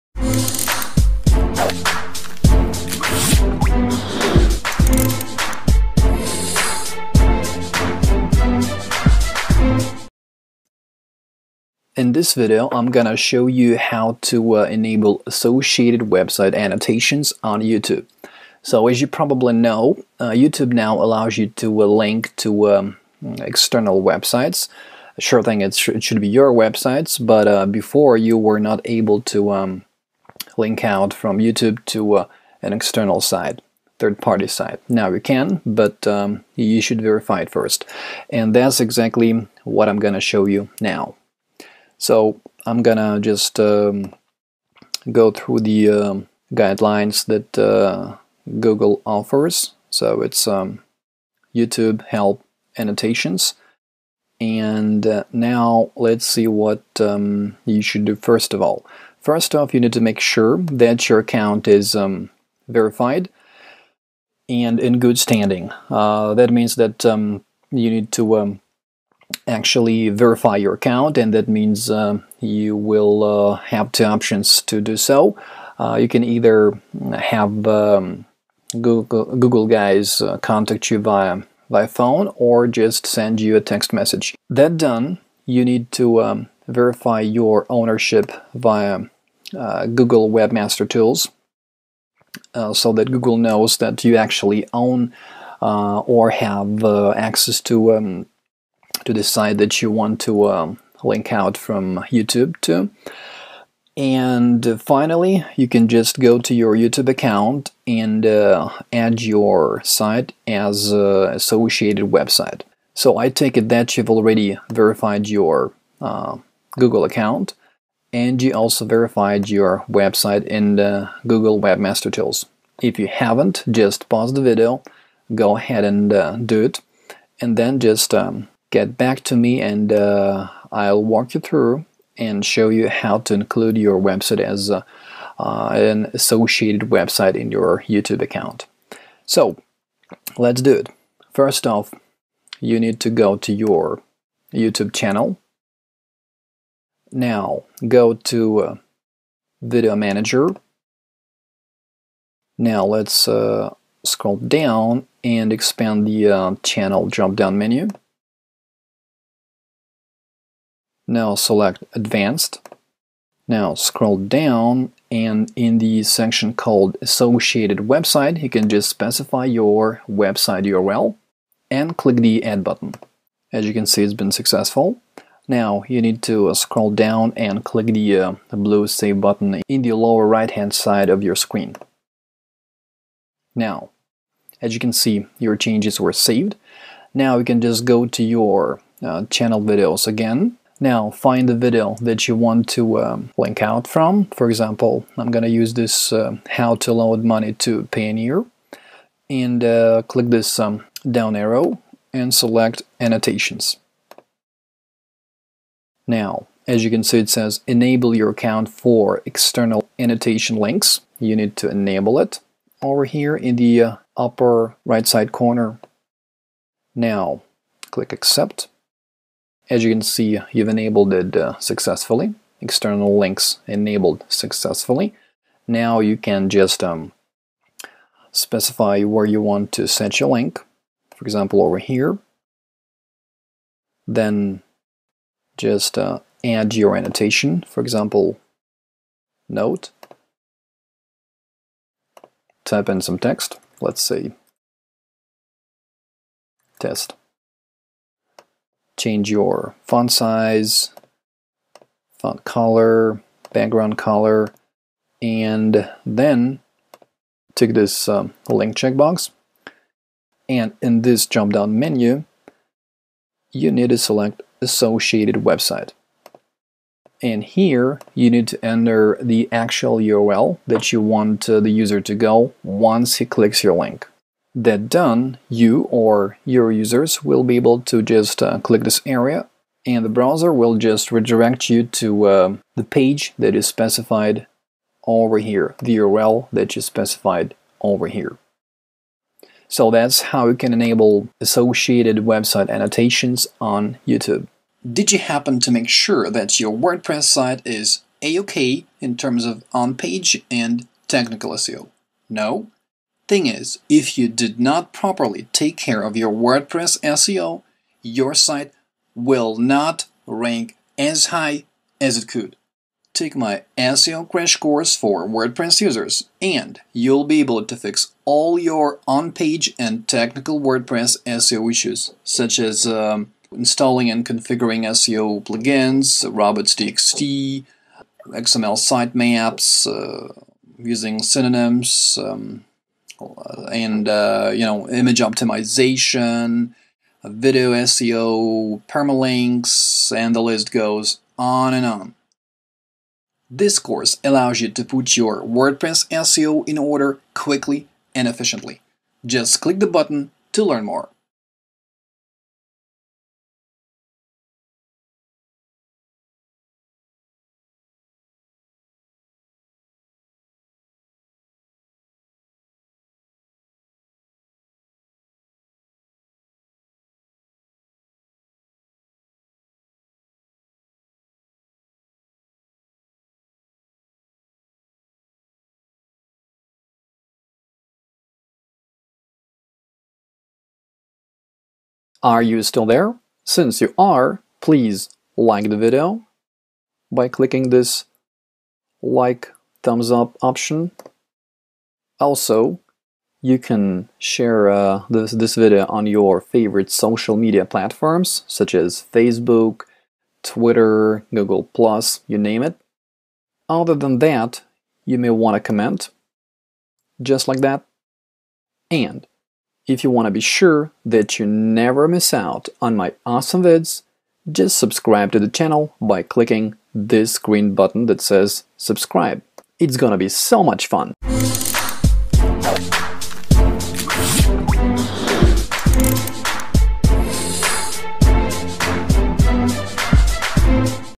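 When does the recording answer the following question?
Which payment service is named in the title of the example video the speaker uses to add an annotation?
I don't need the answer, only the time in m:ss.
3:17.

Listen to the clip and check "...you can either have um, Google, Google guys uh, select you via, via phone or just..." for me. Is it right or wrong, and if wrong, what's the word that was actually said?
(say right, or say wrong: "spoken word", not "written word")
wrong: "contact", not "select".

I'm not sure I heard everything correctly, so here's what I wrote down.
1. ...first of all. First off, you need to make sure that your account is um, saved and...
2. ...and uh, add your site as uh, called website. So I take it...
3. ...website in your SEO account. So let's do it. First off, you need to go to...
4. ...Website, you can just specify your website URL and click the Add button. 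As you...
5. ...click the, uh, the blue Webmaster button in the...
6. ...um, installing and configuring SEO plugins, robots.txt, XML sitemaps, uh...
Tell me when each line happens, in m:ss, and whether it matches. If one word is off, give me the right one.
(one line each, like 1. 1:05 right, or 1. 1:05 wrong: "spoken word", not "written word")
1. 0:58 wrong: "verified", not "saved"
2. 1:47 wrong: "associated", not "called"
3. 2:16 wrong: "YouTube", not "SEO"
4. 2:47 right
5. 2:57 wrong: "Save", not "Webmaster"
6. 5:22 right.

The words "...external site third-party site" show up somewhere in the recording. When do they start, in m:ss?
0:32.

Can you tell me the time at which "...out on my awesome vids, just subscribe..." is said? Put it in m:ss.
6:52.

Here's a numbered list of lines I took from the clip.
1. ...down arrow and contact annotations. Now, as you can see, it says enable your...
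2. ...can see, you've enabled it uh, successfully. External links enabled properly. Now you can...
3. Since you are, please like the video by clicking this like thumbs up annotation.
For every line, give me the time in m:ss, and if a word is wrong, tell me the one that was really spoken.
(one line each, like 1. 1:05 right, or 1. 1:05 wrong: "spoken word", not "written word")
1. 3:21 wrong: "select", not "contact"
2. 3:39 wrong: "successfully", not "properly"
3. 6:23 wrong: "option", not "annotation".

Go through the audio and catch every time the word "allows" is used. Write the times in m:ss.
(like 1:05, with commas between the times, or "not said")
0:20, 5:44.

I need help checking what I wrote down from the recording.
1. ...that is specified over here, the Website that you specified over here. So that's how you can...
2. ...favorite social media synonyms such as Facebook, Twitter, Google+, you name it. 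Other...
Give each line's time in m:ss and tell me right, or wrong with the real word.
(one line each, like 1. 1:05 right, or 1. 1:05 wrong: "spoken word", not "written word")
1. 4:43 wrong: "URL", not "Website"
2. 6:36 wrong: "platforms", not "synonyms".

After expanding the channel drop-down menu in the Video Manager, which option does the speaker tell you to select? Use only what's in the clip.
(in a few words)
Advanced.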